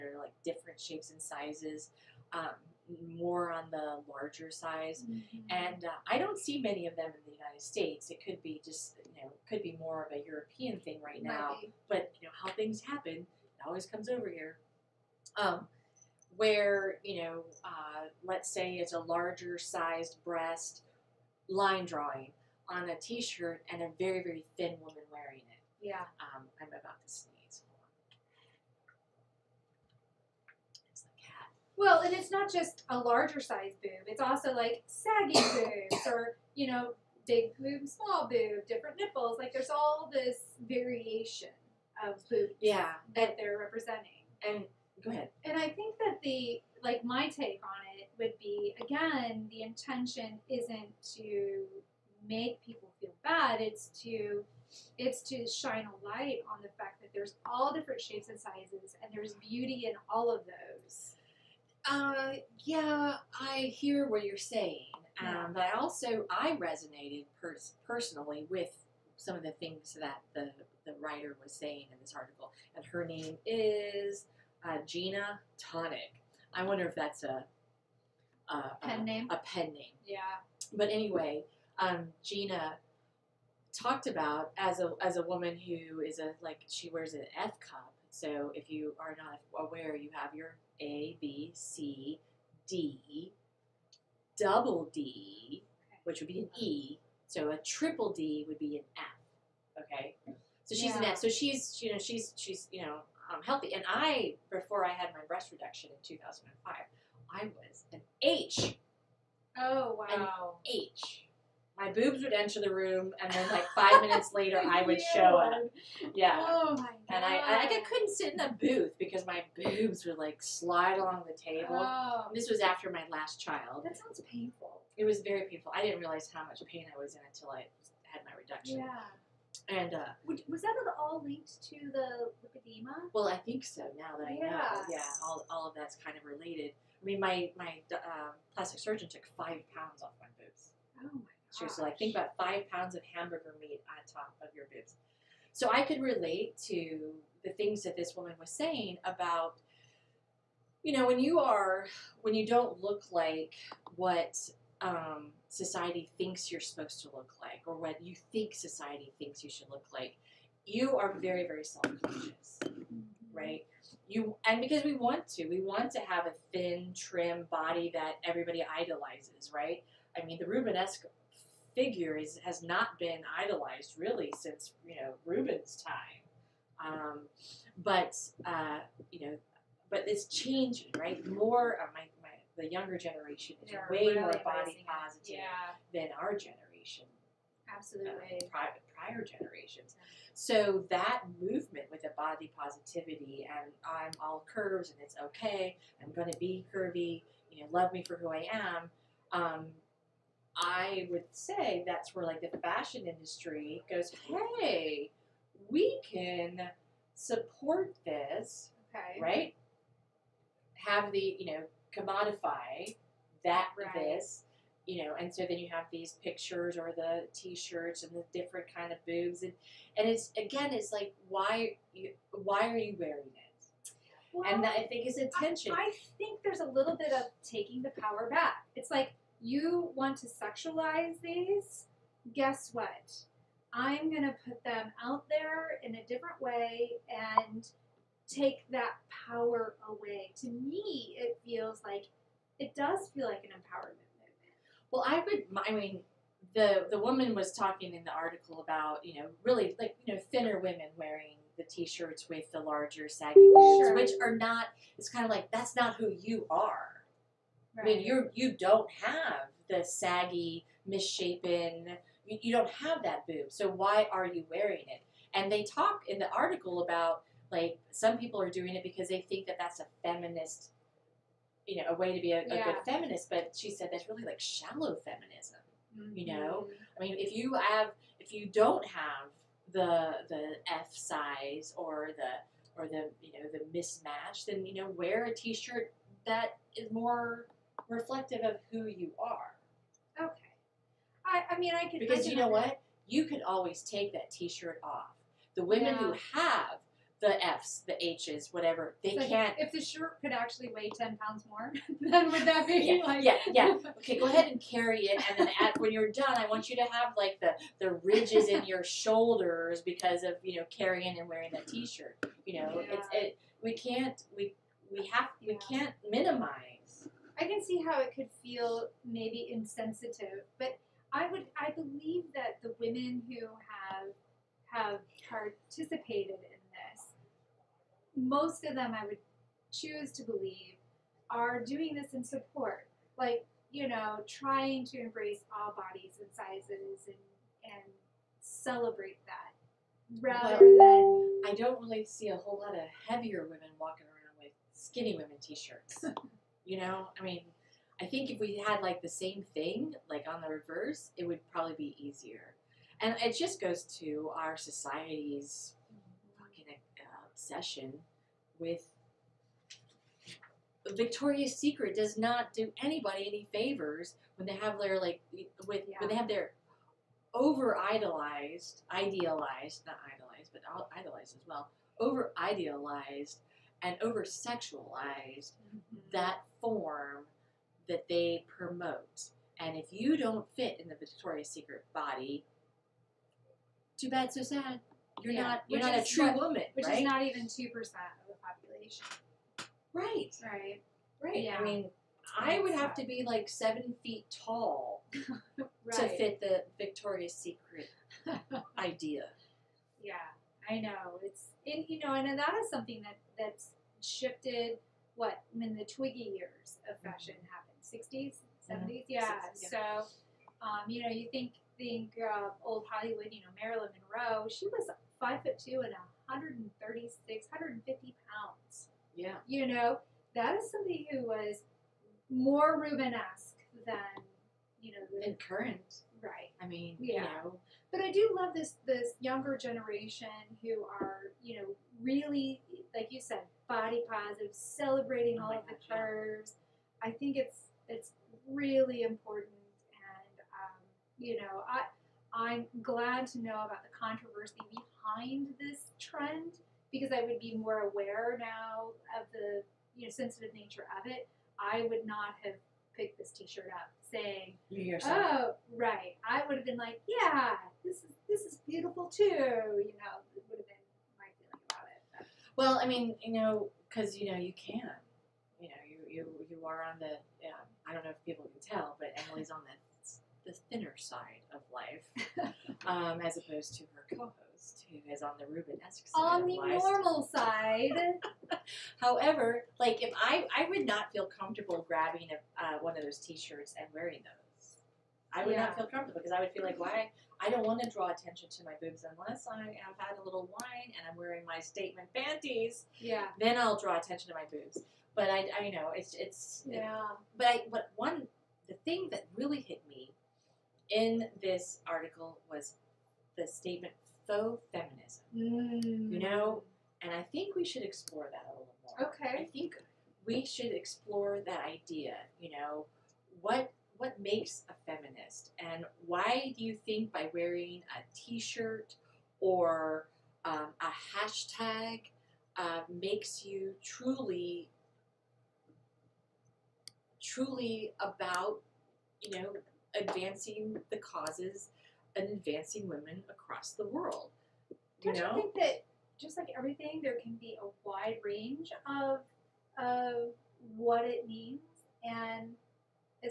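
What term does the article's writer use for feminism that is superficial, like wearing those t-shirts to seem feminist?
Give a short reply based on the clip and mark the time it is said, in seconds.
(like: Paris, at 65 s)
shallow feminism, at 274 s.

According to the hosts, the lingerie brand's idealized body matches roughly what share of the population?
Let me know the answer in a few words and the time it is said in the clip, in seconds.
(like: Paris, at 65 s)
2 percent, at 387 s.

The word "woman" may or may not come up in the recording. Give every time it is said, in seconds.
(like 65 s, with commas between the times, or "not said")
24 s, 85 s, 148 s, 246 s, 386 s.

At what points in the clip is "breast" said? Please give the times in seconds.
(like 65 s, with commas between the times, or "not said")
20 s, 105 s.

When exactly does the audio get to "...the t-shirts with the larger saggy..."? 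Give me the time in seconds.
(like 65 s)
251 s.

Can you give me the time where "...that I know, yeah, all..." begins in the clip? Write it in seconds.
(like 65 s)
134 s.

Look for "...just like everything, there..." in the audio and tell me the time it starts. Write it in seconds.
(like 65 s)
536 s.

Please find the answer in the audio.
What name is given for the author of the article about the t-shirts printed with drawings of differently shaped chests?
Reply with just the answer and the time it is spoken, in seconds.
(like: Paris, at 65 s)
Gina Tonic, at 74 s.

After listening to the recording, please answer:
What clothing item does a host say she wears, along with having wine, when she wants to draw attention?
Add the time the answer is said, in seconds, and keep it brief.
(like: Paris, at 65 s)
statement panties, at 491 s.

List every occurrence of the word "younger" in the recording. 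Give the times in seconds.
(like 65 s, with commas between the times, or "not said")
182 s, 429 s.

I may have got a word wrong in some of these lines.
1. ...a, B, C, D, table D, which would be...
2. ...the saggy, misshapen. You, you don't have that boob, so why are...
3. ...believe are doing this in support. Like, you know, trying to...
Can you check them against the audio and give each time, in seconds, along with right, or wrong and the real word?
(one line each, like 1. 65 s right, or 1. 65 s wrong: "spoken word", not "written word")
1. 90 s wrong: "double", not "table"
2. 259 s right
3. 330 s right.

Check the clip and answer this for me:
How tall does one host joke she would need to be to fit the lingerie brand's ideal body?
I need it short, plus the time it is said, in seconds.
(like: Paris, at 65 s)
7 feet, at 393 s.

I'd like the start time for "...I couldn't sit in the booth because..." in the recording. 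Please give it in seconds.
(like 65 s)
117 s.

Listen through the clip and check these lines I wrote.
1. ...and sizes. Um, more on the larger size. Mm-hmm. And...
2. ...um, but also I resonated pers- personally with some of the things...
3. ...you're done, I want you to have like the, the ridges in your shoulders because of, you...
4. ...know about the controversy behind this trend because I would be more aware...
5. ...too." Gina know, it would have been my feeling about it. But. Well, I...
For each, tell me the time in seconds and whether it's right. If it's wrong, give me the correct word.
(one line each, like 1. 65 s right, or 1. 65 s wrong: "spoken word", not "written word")
1. 1 s right
2. 65 s right
3. 305 s right
4. 443 s right
5. 459 s wrong: "You", not "Gina".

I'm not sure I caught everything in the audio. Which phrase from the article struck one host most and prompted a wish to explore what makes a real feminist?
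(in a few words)
faux feminism.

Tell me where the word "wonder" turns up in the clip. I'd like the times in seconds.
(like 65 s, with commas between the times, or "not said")
76 s.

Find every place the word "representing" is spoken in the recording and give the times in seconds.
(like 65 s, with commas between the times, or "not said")
43 s.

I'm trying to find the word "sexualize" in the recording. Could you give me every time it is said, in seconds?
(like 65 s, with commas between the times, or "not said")
230 s, 374 s.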